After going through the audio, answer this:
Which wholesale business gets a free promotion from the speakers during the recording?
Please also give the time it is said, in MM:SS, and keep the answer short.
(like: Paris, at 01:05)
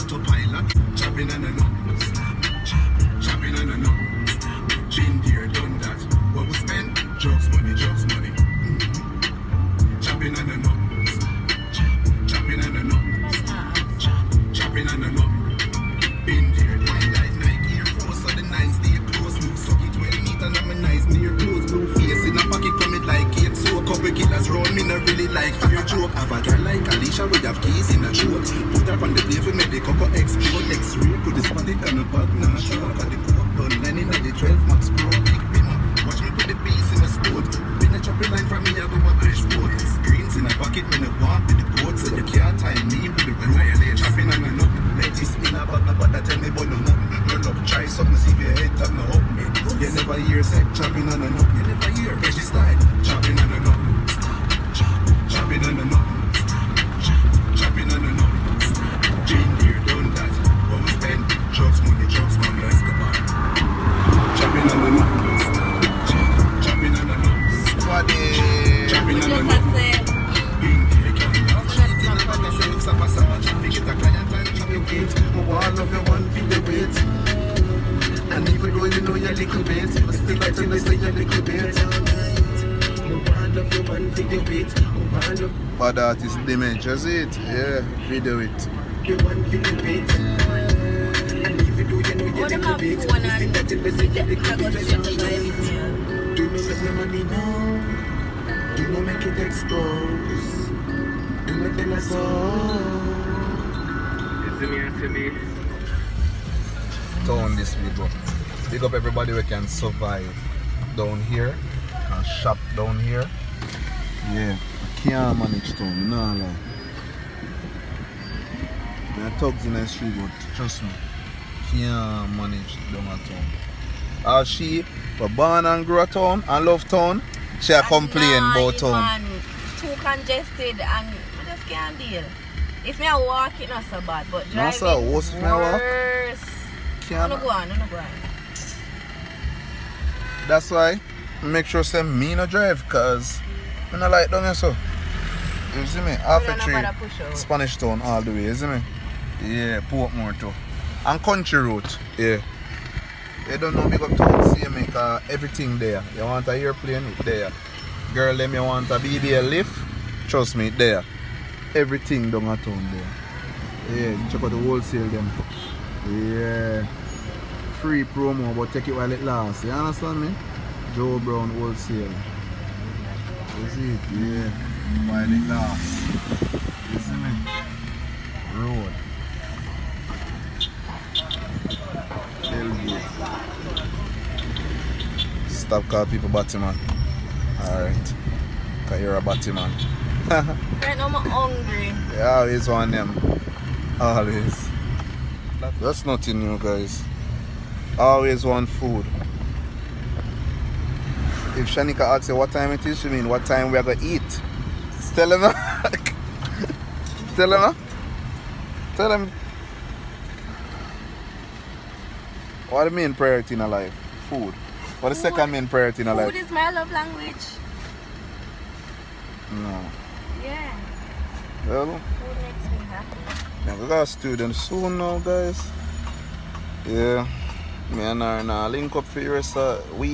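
Joe Brown wholesale, at 02:50.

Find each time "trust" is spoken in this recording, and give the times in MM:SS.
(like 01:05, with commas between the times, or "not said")
02:00, 02:40.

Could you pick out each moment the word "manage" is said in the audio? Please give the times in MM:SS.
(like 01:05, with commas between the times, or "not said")
01:55, 02:02.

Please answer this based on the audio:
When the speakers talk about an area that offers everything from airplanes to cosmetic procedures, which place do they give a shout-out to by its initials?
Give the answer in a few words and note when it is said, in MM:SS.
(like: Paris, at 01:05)
CMA, at 02:34.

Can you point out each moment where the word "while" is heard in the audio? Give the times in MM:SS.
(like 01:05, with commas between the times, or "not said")
02:48, 02:55.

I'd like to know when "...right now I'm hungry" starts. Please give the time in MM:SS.
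03:10.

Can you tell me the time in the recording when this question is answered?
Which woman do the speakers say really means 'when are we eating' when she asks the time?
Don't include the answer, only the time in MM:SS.
03:21.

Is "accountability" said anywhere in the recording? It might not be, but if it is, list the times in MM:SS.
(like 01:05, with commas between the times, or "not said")
not said.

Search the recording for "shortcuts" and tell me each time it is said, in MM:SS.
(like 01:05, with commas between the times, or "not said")
not said.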